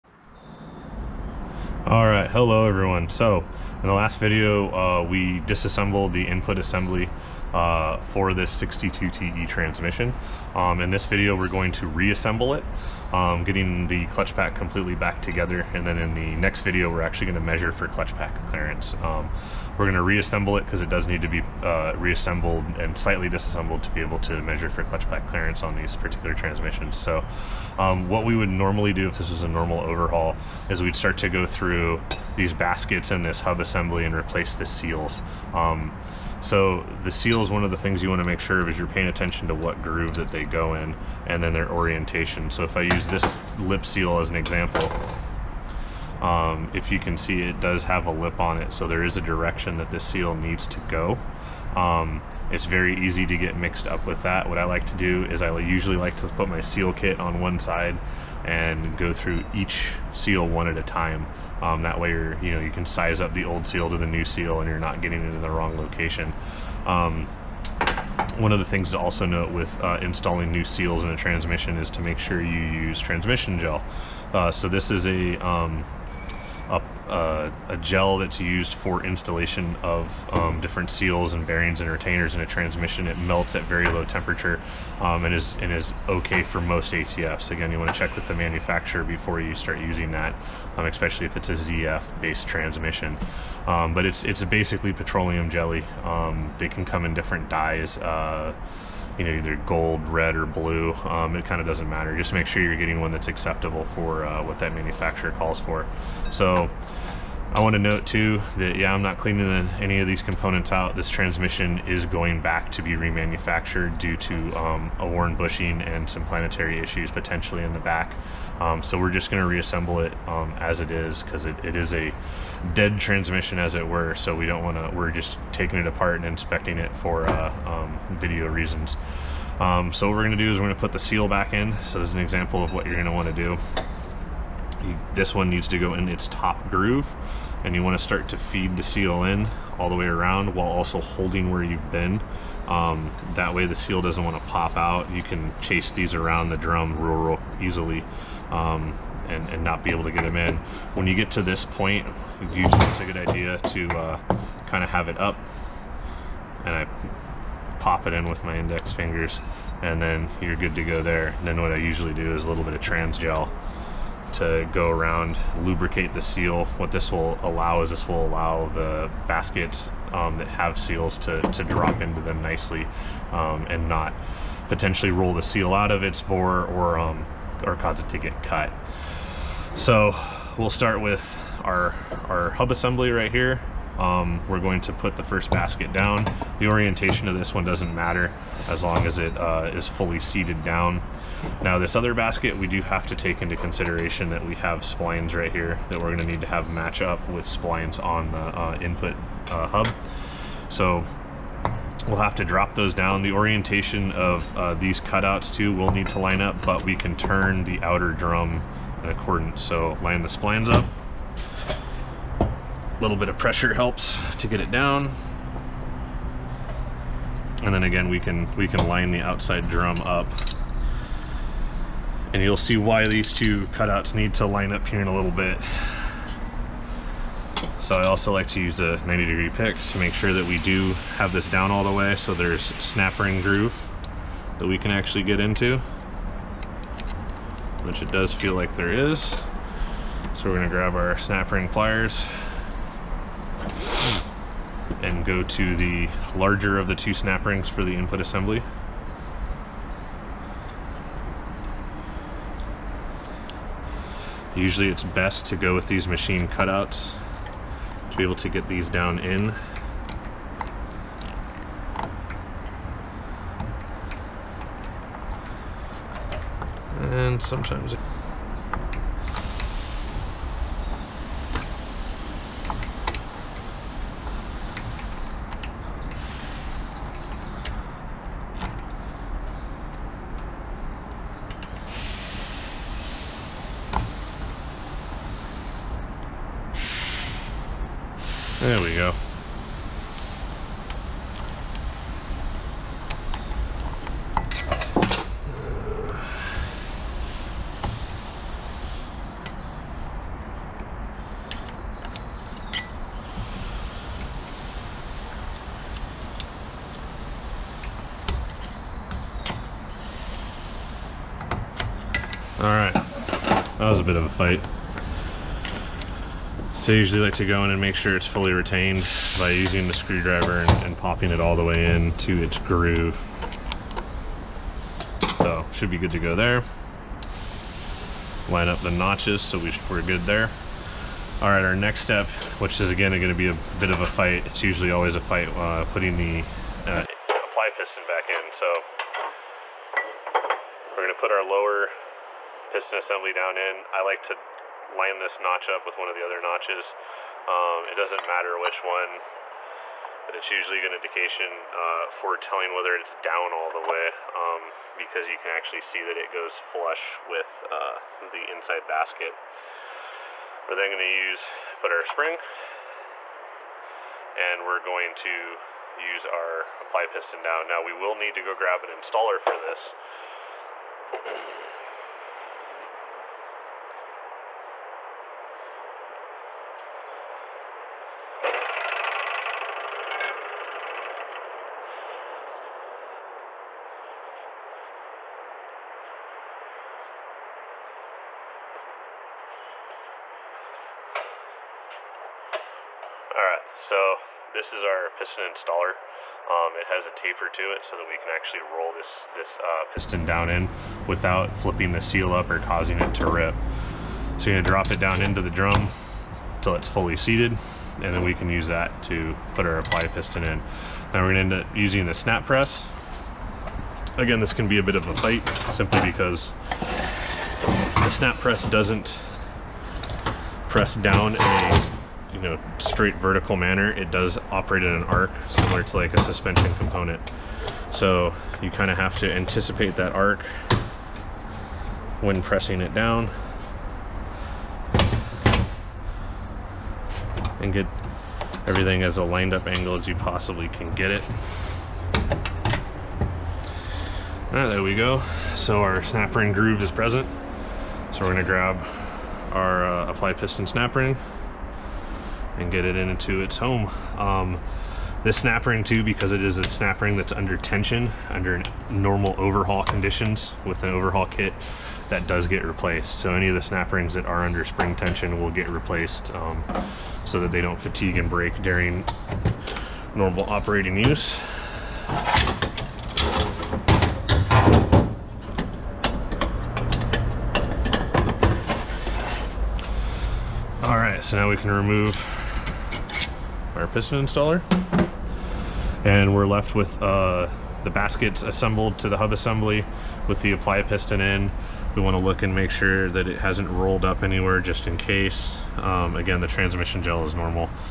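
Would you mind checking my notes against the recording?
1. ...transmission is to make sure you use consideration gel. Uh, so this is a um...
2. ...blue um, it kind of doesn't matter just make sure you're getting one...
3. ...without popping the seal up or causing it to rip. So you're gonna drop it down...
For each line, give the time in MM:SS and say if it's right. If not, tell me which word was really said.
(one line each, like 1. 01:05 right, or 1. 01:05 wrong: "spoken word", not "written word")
1. 01:11 wrong: "transmission", not "consideration"
2. 01:40 right
3. 06:41 wrong: "flipping", not "popping".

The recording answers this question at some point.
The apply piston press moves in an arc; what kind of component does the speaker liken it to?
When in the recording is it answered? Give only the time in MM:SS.
07:06.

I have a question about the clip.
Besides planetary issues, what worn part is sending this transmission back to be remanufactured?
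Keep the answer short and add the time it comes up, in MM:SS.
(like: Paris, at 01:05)
bushing, at 01:55.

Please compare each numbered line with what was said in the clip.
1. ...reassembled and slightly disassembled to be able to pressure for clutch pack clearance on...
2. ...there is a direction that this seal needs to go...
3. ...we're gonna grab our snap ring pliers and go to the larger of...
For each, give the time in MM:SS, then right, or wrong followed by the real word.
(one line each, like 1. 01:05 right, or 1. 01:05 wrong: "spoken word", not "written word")
1. 00:21 wrong: "measure", not "pressure"
2. 00:48 right
3. 04:00 right.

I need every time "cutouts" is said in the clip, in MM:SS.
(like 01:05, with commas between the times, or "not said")
03:25, 03:43, 04:16.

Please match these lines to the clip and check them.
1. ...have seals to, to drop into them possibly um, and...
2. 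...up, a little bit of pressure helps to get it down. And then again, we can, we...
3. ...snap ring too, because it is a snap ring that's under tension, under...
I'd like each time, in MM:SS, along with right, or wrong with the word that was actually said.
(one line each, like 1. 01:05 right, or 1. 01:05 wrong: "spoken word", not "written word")
1. 02:50 wrong: "nicely", not "possibly"
2. 03:30 right
3. 07:35 right.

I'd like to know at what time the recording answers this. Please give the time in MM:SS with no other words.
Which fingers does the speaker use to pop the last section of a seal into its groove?
02:38.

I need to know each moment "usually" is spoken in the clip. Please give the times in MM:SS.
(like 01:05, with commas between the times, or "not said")
00:55, 02:32, 02:41, 04:14, 05:16, 05:34, 05:50.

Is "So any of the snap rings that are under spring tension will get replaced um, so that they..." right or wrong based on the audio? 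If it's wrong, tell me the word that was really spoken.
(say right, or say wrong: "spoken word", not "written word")
right.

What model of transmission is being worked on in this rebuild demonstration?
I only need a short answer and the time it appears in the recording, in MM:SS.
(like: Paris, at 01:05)
62TE, at 00:08.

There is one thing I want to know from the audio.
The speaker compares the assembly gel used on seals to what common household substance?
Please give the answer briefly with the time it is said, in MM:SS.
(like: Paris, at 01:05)
petroleum jelly, at 01:34.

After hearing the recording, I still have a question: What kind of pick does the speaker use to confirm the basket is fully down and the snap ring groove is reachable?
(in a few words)
90 degree pick.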